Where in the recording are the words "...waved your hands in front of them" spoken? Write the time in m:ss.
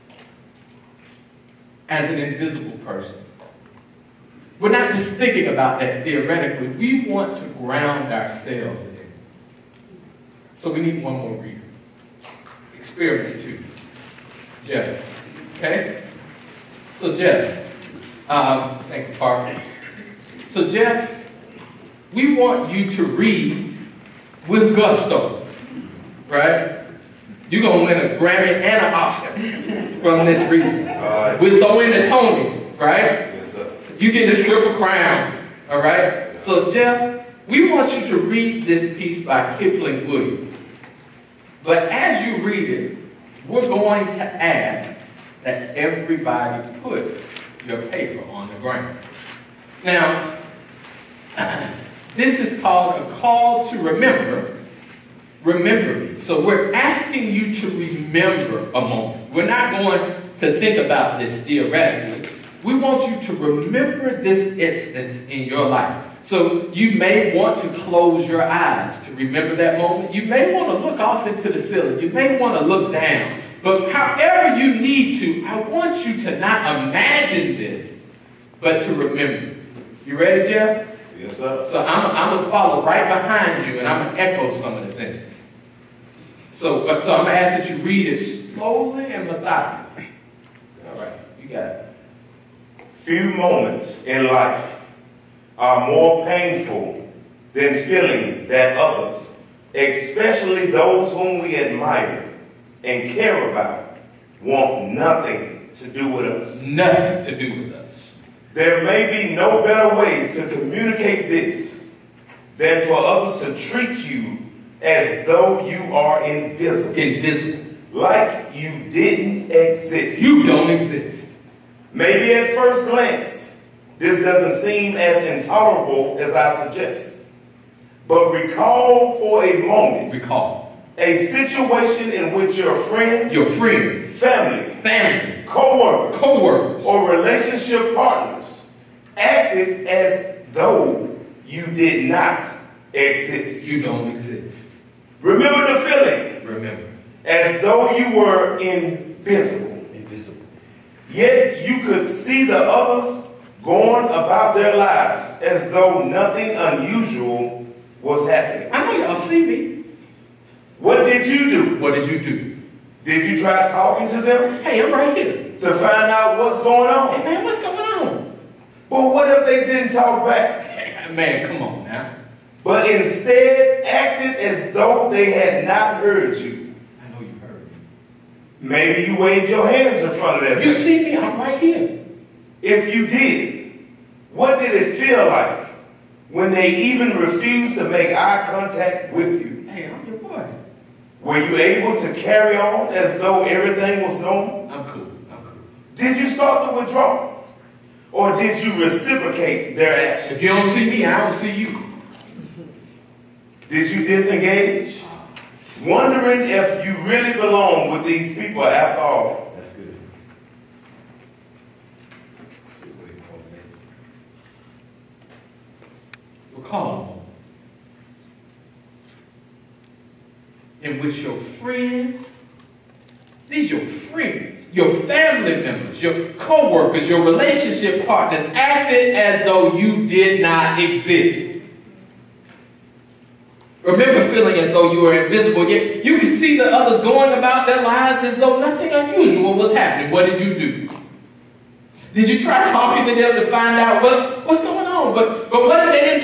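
2:59.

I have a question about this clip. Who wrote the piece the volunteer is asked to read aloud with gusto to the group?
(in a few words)
Kipling Williams.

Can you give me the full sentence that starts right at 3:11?
Were you able to carry on as though everything was normal?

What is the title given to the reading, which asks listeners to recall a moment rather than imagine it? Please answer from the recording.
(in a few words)
A call to remember.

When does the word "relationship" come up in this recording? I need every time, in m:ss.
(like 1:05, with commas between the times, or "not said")
2:17, 3:47.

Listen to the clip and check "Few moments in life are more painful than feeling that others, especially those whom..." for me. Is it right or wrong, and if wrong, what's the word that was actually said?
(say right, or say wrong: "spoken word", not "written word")
right.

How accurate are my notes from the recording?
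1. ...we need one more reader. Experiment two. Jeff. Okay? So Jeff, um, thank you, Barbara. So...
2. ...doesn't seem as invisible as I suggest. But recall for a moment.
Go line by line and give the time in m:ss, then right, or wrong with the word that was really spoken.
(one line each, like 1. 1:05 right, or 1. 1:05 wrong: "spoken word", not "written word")
1. 0:10 right
2. 2:04 wrong: "intolerable", not "invisible".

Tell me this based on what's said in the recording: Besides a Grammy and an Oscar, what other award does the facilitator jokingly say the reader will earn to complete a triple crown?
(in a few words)
Tony.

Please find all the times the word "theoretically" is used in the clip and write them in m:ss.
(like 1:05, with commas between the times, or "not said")
0:06, 1:01.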